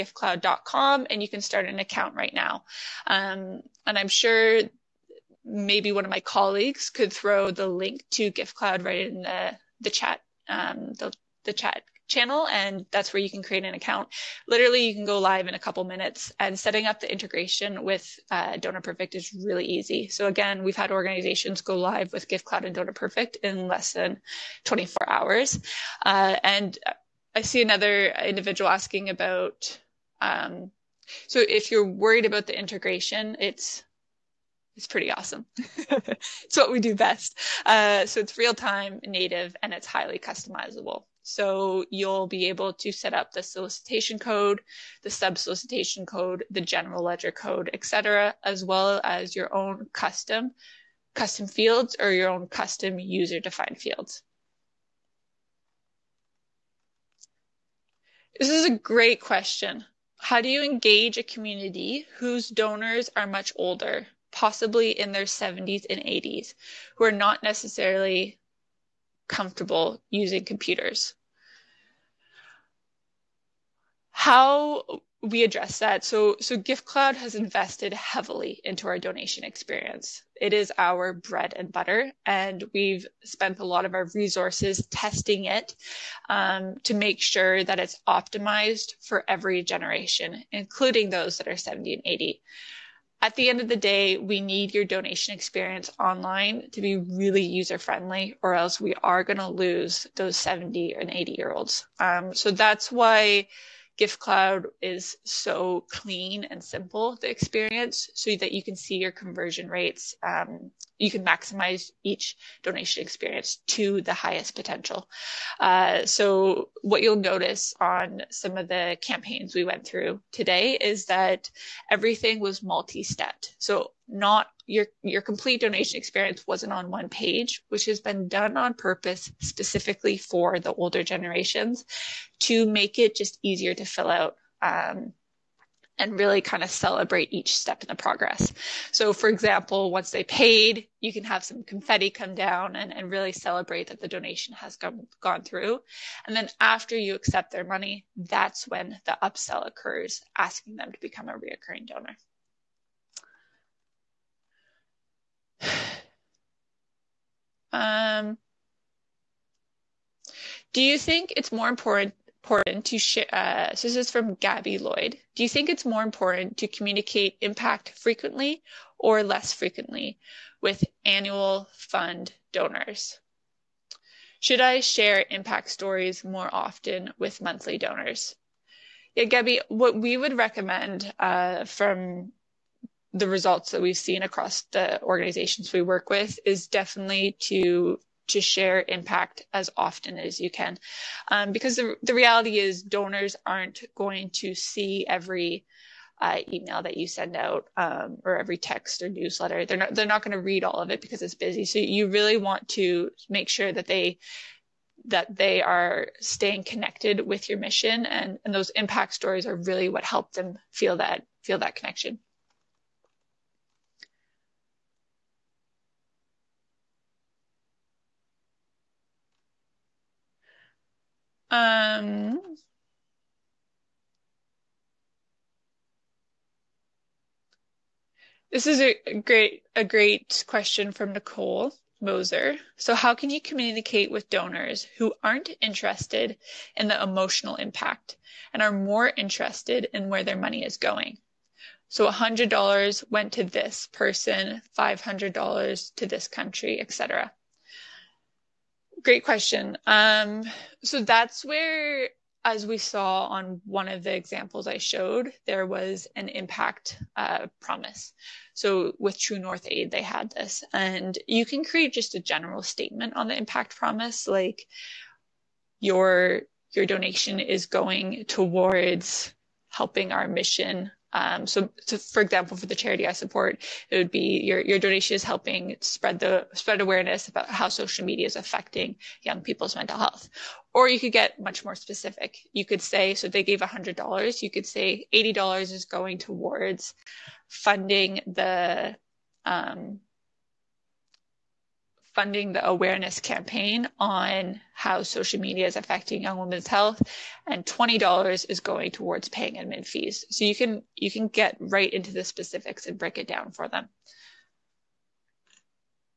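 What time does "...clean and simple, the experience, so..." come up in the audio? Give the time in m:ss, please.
1:45.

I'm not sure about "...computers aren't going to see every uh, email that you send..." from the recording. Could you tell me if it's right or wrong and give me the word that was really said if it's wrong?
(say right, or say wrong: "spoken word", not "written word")
wrong: "donors", not "computers".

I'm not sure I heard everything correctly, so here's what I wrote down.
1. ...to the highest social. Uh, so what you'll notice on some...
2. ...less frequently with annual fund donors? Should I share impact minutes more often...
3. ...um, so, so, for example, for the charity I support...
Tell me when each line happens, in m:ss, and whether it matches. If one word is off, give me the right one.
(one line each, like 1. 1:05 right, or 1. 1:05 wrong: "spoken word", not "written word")
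1. 1:53 wrong: "potential", not "social"
2. 2:49 wrong: "stories", not "minutes"
3. 4:31 right.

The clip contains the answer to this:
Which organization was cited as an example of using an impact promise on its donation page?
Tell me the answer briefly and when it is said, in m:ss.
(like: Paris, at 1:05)
True North Aid, at 4:19.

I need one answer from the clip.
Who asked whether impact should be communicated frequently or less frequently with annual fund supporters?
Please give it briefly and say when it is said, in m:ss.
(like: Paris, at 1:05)
Gabby Lloyd, at 2:44.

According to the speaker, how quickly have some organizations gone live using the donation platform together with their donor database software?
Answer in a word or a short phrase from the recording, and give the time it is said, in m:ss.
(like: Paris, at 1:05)
less than 24 hours, at 0:23.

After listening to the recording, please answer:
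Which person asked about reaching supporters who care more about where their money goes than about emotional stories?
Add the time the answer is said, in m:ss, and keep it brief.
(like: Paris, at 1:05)
Nicole Moser, at 3:51.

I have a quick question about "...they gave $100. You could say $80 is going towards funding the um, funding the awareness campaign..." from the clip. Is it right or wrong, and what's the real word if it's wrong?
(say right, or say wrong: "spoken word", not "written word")
right.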